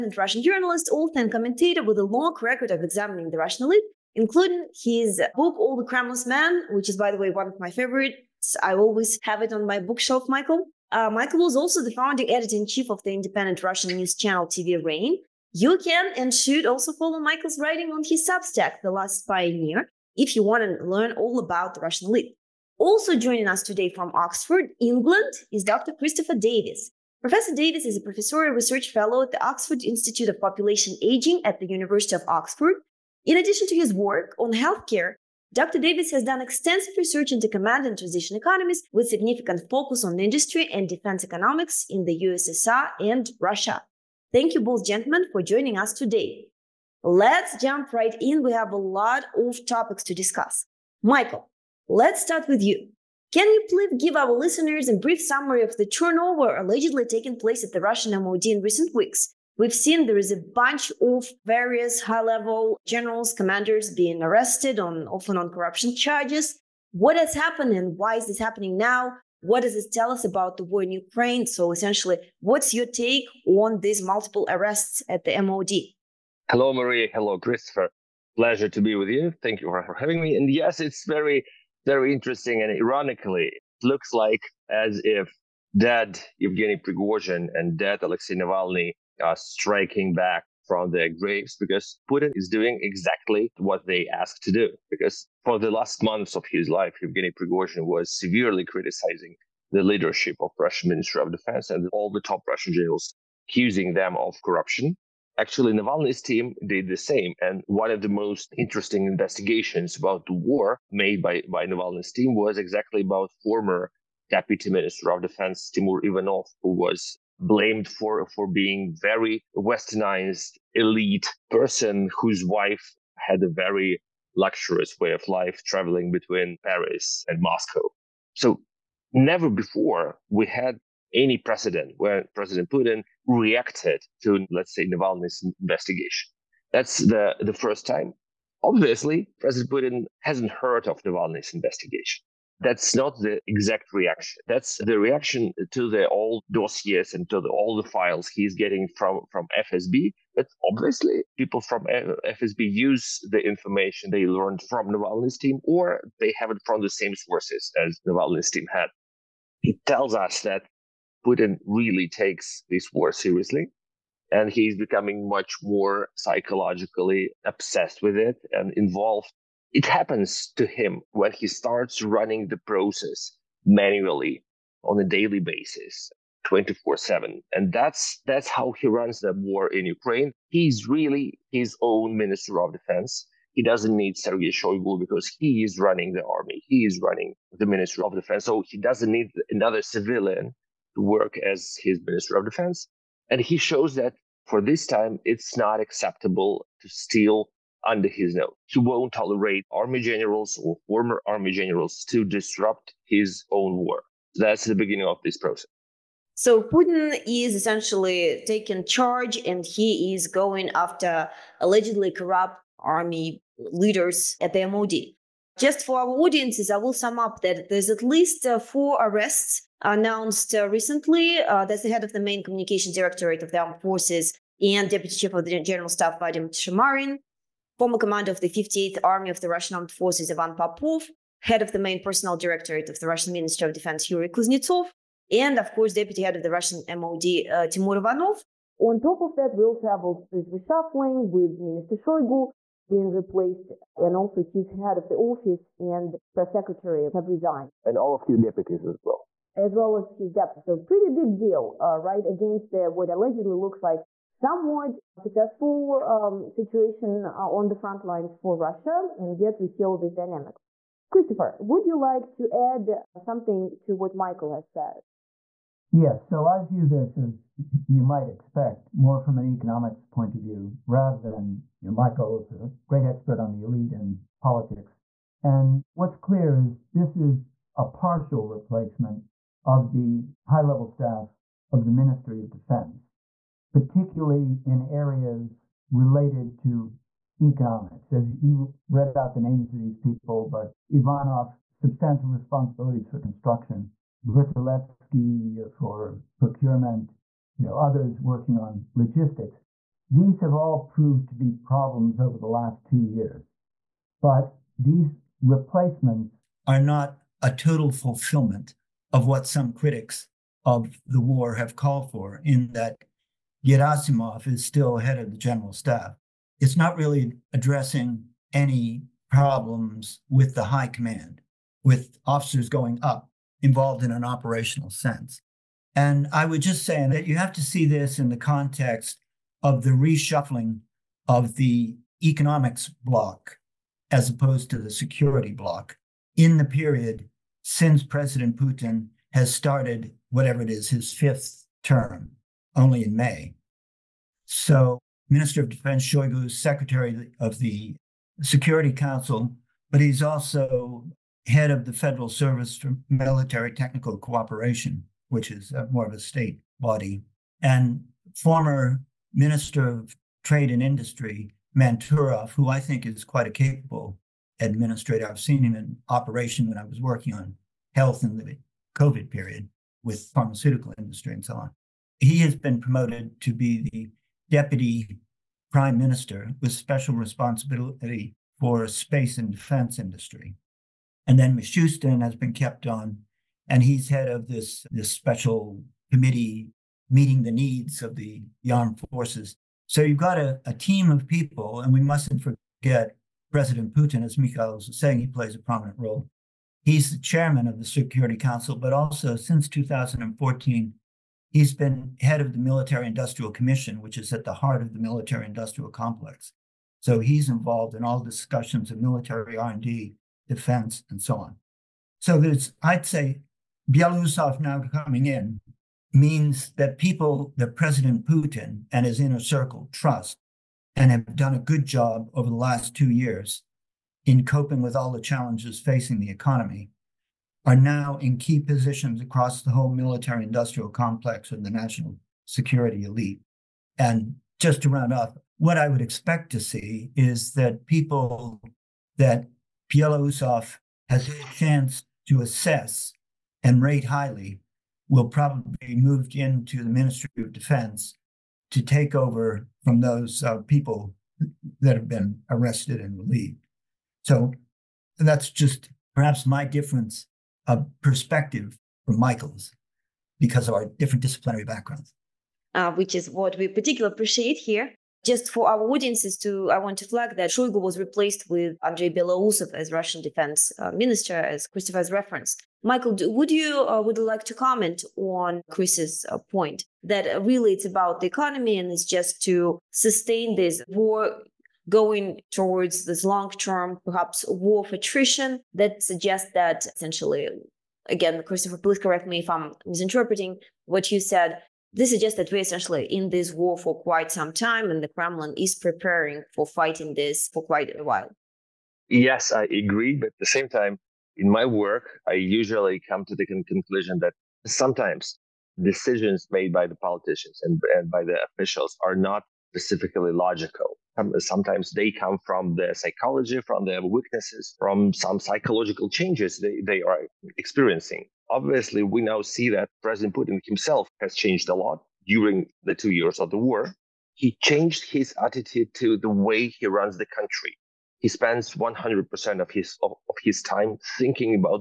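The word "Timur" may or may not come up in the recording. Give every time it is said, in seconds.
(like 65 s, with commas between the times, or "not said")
115 s, 237 s.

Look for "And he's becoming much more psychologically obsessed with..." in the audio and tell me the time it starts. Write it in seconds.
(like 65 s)
164 s.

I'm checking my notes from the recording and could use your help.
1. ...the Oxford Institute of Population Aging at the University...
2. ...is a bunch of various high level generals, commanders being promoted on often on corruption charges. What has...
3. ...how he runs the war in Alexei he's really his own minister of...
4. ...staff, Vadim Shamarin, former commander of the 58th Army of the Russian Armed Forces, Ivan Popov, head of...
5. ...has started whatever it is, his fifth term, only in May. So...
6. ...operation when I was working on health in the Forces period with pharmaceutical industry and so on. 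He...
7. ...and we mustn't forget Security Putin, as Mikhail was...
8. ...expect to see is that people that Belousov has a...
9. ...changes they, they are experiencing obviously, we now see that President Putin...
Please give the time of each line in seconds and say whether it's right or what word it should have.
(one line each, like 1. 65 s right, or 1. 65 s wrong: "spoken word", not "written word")
1. 29 s right
2. 60 s wrong: "arrested", not "promoted"
3. 178 s wrong: "Ukraine", not "Alexei"
4. 225 s right
5. 339 s right
6. 366 s wrong: "COVID", not "Forces"
7. 391 s wrong: "President", not "Security"
8. 436 s right
9. 516 s right.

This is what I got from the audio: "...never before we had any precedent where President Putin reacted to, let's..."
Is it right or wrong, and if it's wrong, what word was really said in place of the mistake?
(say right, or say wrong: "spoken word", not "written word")
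right.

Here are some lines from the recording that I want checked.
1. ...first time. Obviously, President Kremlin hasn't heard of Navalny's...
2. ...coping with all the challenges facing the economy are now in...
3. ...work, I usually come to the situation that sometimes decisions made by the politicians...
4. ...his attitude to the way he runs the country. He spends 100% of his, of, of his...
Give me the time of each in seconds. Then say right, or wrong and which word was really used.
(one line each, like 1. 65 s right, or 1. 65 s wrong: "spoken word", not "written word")
1. 137 s wrong: "Putin", not "Kremlin"
2. 424 s right
3. 501 s wrong: "conclusion", not "situation"
4. 525 s right.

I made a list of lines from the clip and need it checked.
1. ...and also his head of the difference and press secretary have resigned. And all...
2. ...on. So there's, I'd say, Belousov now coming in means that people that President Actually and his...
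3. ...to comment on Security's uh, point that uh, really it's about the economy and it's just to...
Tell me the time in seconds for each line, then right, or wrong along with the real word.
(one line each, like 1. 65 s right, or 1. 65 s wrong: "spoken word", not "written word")
1. 243 s wrong: "office", not "difference"
2. 411 s wrong: "Putin", not "Actually"
3. 474 s wrong: "Chris", not "Security".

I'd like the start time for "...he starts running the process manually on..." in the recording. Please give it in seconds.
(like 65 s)
171 s.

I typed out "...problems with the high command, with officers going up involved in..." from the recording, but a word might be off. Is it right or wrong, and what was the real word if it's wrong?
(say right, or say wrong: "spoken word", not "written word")
right.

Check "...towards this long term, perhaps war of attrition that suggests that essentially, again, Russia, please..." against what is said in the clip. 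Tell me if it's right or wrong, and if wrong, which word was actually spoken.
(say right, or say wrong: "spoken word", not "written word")
wrong: "Christopher", not "Russia".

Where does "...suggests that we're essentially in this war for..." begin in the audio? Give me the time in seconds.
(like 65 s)
492 s.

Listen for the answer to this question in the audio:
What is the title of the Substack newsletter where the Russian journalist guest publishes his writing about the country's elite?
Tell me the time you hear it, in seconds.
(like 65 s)
18 s.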